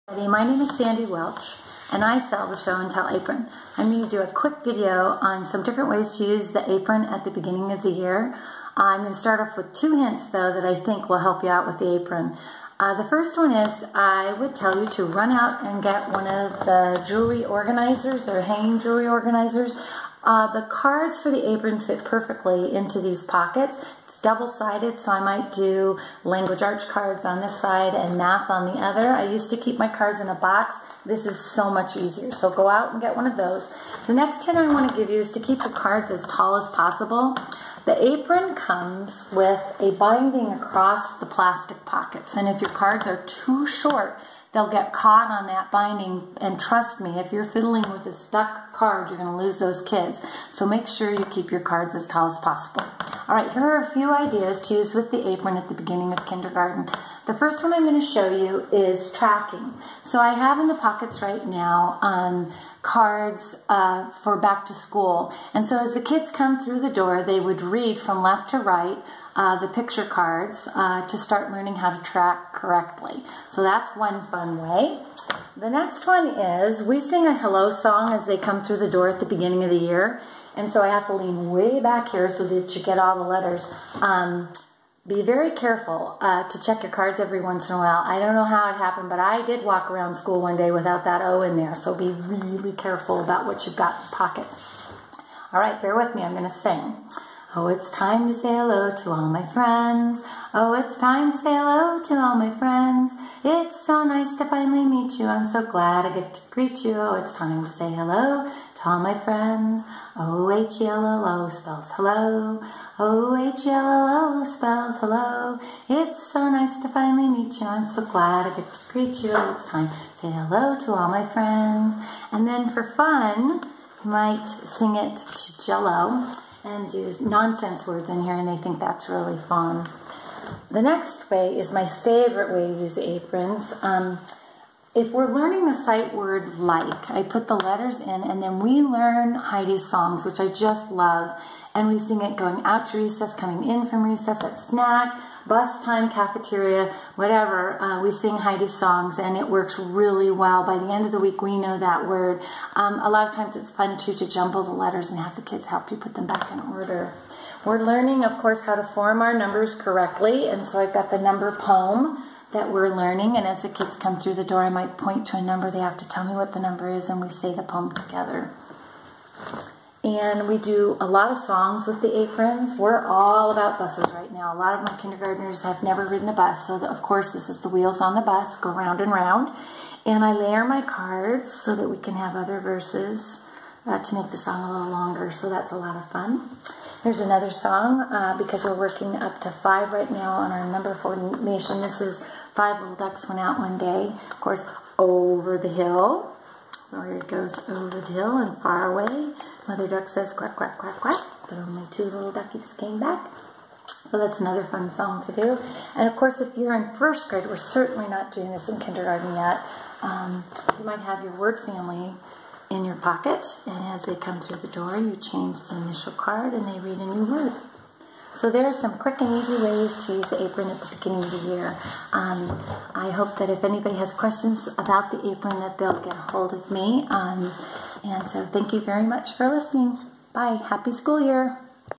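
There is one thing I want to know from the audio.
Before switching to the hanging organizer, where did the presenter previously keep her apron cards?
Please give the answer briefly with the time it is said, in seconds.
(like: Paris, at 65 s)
in a box, at 30 s.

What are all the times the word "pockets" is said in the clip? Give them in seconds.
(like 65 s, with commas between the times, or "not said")
23 s, 41 s, 60 s, 94 s, 212 s.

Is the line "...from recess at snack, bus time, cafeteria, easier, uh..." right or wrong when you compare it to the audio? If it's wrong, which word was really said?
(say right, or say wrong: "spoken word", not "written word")
wrong: "whatever", not "easier".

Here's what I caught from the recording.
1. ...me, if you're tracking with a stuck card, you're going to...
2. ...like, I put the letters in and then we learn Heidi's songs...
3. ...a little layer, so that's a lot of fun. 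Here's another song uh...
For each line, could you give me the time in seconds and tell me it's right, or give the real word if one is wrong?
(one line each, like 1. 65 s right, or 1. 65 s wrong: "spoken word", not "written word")
1. 47 s wrong: "fiddling", not "tracking"
2. 136 s right
3. 184 s wrong: "longer", not "layer".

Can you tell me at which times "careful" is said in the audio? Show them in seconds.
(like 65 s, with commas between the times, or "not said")
85 s, 92 s.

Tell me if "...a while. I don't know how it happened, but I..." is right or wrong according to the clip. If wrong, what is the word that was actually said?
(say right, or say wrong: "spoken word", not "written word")
right.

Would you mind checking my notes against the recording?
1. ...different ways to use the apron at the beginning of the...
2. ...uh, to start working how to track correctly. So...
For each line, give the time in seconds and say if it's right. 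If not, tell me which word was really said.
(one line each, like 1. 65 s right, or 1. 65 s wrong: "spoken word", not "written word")
1. 5 s right
2. 70 s wrong: "learning", not "working".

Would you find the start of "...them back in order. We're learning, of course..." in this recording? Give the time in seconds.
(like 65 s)
156 s.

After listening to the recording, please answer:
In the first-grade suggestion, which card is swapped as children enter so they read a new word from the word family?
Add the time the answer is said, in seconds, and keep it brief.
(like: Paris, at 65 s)
the initial card, at 215 s.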